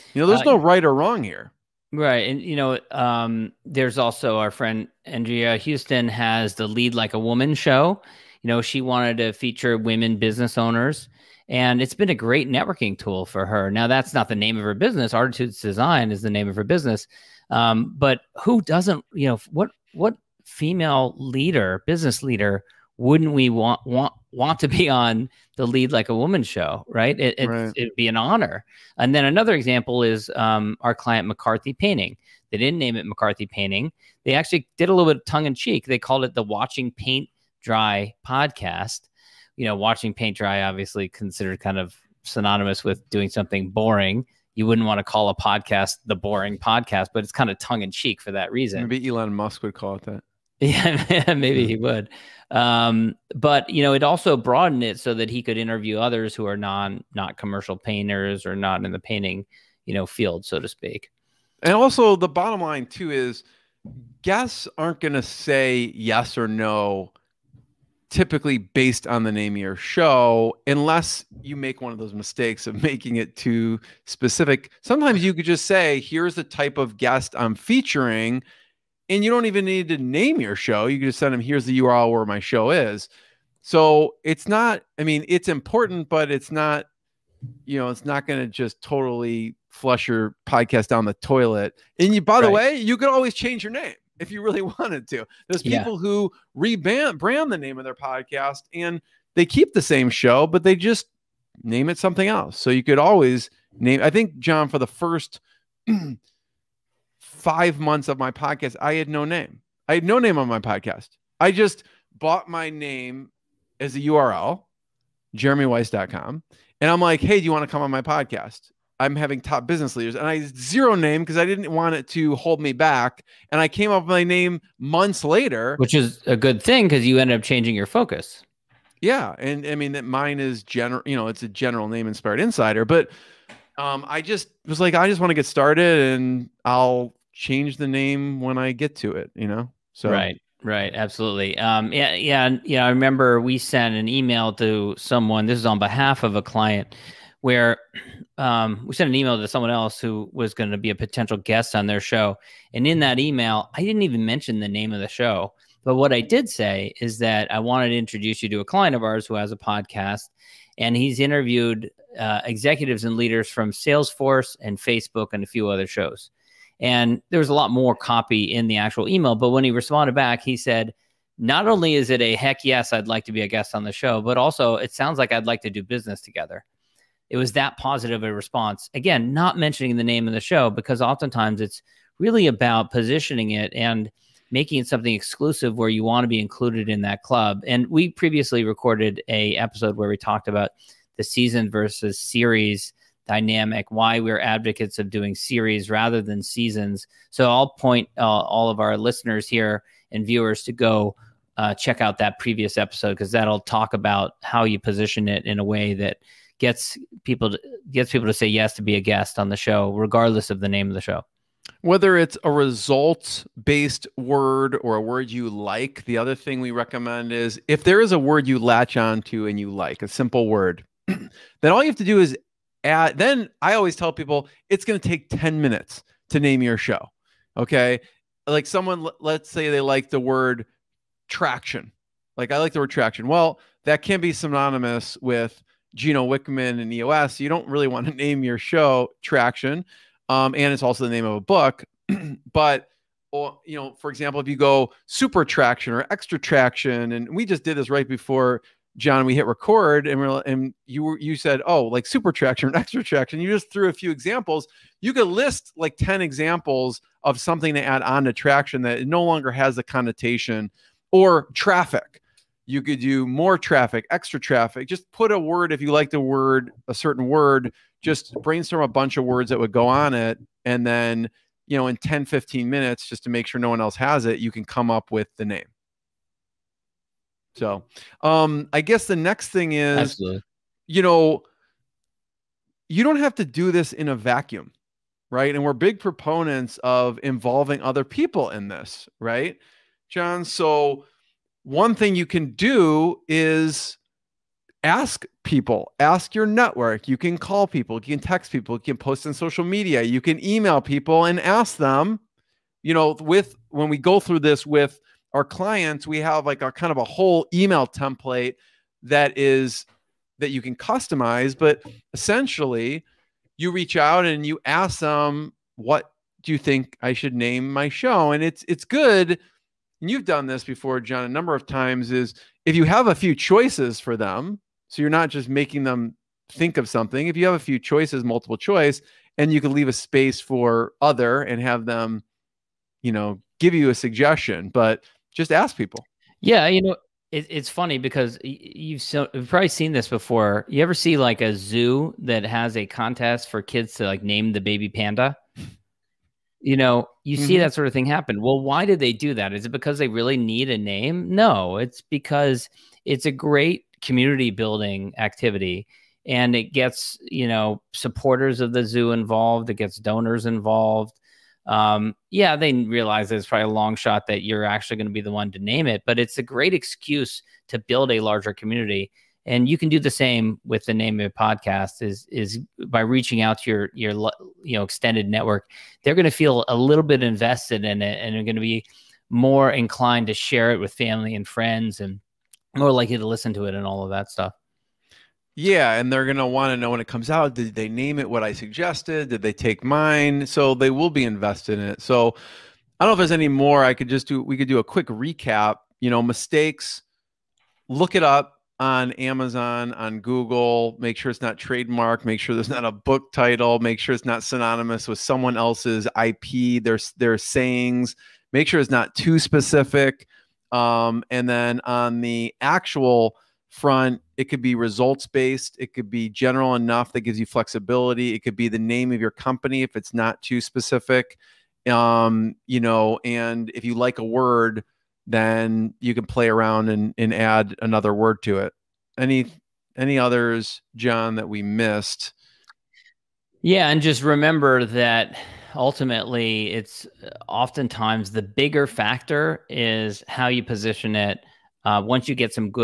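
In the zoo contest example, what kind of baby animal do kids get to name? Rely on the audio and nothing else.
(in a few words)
panda.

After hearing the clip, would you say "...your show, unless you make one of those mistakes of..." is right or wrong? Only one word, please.
right.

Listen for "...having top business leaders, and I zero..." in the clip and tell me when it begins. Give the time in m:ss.
1:59.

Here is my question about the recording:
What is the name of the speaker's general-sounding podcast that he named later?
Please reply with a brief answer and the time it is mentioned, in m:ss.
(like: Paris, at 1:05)
Inspired Insider, at 2:12.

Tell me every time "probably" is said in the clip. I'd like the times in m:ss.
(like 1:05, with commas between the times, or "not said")
5:39, 6:03.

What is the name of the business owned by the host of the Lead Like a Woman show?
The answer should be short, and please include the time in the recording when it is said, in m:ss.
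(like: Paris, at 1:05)
Artitudes Design, at 0:15.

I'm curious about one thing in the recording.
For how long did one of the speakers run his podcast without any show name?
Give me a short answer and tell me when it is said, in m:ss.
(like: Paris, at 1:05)
5 months, at 1:47.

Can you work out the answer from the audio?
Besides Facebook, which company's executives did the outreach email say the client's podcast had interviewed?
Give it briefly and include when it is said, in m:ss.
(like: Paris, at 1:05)
Salesforce, at 2:43.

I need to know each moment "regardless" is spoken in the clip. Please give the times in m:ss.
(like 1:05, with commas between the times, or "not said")
3:29.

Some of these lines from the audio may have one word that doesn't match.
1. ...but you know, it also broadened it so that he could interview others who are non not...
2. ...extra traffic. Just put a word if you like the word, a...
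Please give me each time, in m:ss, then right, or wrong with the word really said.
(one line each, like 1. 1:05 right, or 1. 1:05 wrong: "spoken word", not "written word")
1. 0:53 right
2. 4:24 right.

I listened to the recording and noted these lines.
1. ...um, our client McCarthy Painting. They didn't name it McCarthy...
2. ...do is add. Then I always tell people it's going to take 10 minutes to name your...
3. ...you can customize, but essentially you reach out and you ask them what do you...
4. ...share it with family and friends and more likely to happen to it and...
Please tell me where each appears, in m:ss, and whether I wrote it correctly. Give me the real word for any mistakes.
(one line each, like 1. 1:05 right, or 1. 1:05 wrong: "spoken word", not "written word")
1. 0:30 right
2. 3:42 right
3. 5:10 right
4. 6:20 wrong: "listen", not "happen".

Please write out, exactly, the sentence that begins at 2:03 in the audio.
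And I came up with my name months later, which is a good thing because you ended up changing your focus.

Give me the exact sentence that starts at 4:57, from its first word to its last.
You can call people, you can text people, you can post on social media, you can email people and ask them.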